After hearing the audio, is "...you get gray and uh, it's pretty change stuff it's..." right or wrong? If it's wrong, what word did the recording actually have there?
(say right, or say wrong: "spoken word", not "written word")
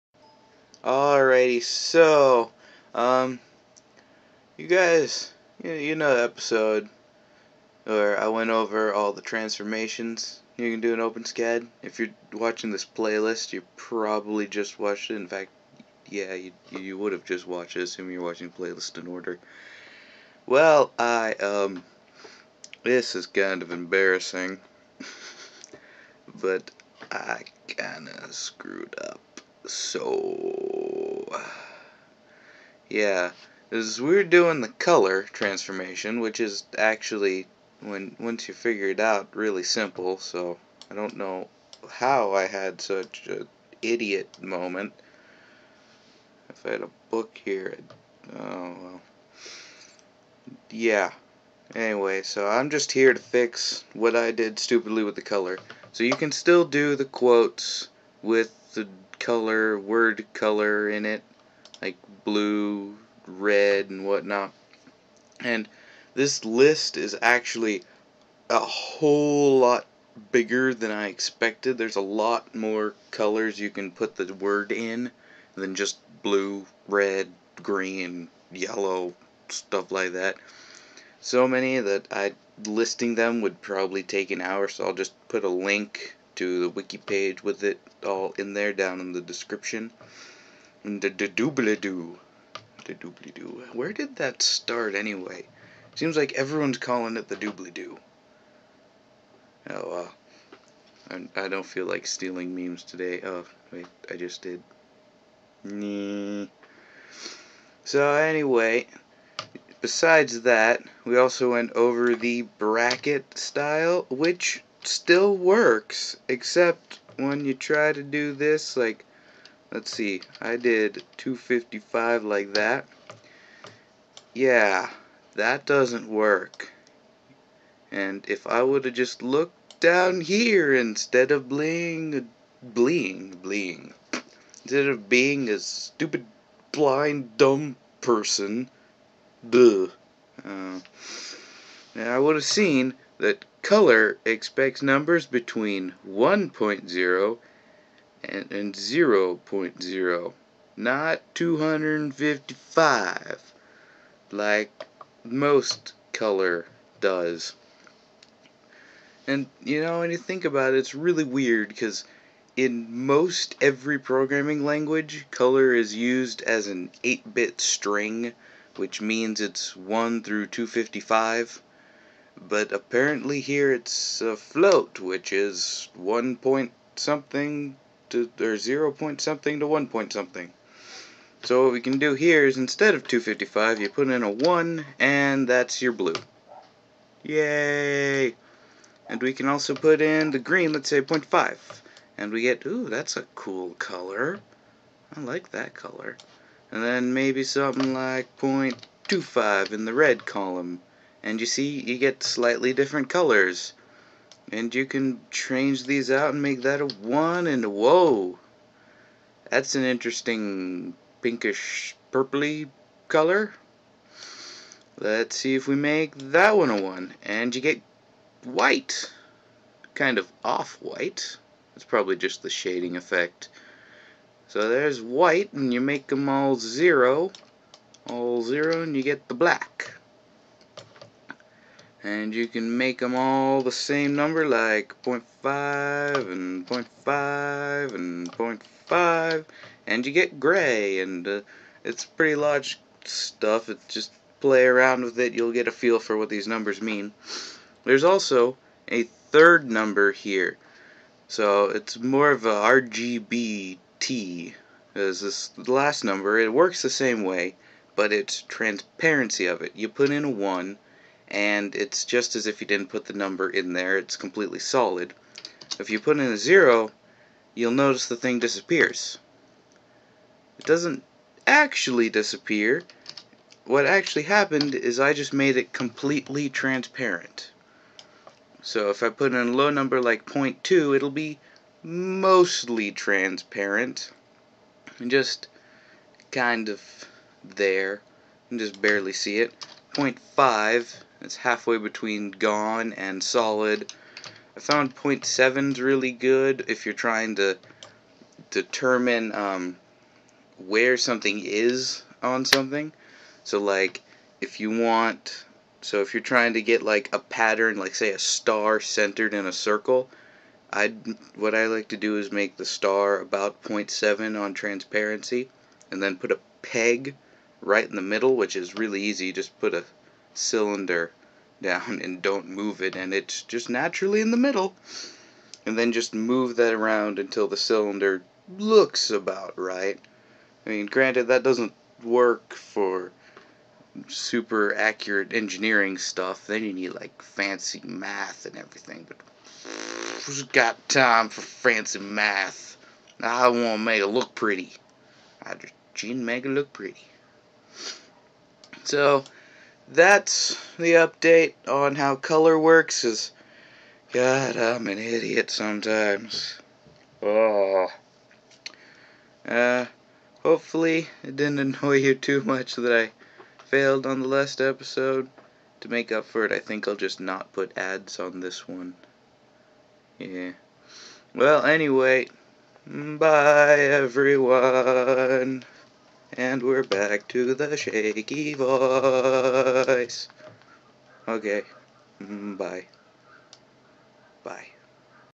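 wrong: "large", not "change".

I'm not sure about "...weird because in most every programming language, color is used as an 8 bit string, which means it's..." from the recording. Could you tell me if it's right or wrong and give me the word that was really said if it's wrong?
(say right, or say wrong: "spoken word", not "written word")
right.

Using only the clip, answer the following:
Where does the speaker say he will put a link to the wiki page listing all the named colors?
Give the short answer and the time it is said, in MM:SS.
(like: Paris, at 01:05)
In the description, at 01:28.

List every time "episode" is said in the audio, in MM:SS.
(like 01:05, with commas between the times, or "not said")
00:06, 06:04.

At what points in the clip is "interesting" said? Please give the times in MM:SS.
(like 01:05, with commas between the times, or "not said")
03:29.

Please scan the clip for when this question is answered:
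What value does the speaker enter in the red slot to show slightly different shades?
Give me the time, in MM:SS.
03:18.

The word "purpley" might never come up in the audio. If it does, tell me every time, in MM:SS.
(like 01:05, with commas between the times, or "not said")
03:32.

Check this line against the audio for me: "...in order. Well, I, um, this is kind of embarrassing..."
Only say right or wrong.
right.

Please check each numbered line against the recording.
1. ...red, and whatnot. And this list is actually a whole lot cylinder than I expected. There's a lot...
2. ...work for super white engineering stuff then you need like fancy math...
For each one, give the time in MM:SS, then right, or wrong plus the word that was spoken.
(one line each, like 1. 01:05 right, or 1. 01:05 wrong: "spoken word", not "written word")
1. 01:03 wrong: "bigger", not "cylinder"
2. 05:32 wrong: "accurate", not "white".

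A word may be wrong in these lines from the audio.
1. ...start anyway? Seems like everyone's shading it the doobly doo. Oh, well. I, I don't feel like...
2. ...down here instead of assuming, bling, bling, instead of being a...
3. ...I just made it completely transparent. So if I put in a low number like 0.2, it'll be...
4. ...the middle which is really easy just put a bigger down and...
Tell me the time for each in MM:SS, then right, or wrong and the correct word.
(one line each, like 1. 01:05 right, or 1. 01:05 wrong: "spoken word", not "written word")
1. 01:34 wrong: "calling", not "shading"
2. 02:09 wrong: "bling", not "assuming"
3. 04:34 right
4. 05:17 wrong: "cylinder", not "bigger".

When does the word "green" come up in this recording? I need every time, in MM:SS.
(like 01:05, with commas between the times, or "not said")
01:17, 03:10.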